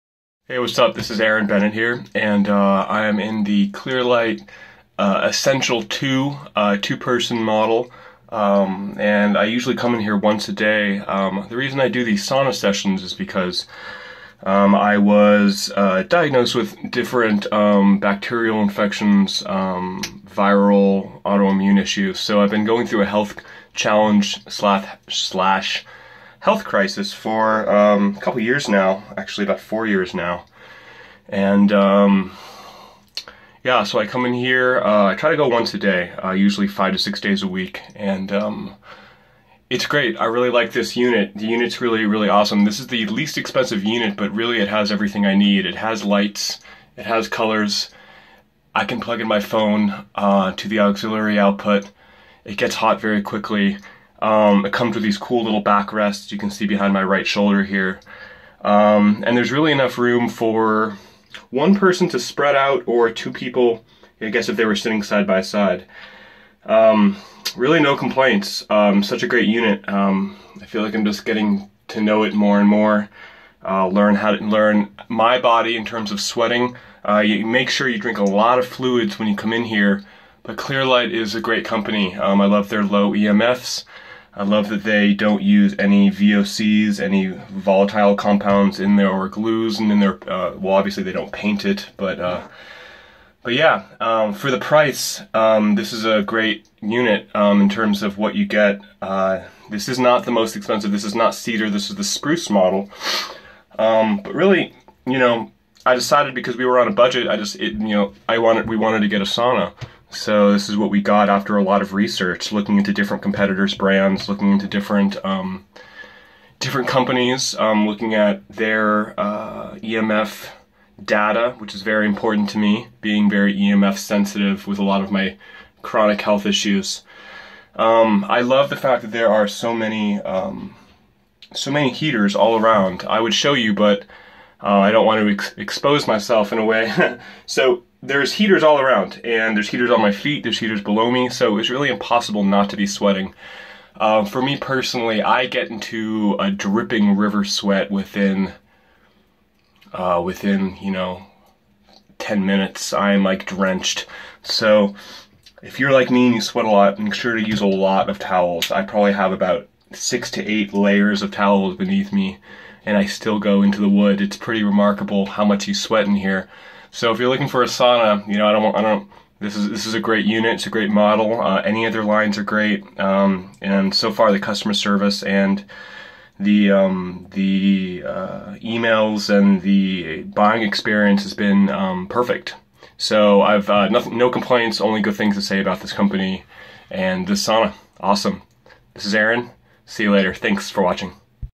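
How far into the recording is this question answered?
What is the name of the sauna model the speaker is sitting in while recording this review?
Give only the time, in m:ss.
0:03.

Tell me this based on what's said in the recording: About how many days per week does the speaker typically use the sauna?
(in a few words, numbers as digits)
5 to 6.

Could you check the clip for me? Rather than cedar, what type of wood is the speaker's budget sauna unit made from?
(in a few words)
spruce.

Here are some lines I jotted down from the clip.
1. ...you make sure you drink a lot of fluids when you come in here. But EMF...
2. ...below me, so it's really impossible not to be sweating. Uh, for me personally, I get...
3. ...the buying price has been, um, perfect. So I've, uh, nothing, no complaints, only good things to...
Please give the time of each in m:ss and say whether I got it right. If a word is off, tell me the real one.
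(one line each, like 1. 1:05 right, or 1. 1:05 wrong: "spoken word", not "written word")
1. 1:17 wrong: "Clearlight", not "EMF"
2. 2:20 right
3. 2:59 wrong: "experience", not "price".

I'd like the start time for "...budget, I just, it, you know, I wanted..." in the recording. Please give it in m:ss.
1:46.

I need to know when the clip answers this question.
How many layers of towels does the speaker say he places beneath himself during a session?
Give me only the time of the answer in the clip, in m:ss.
2:39.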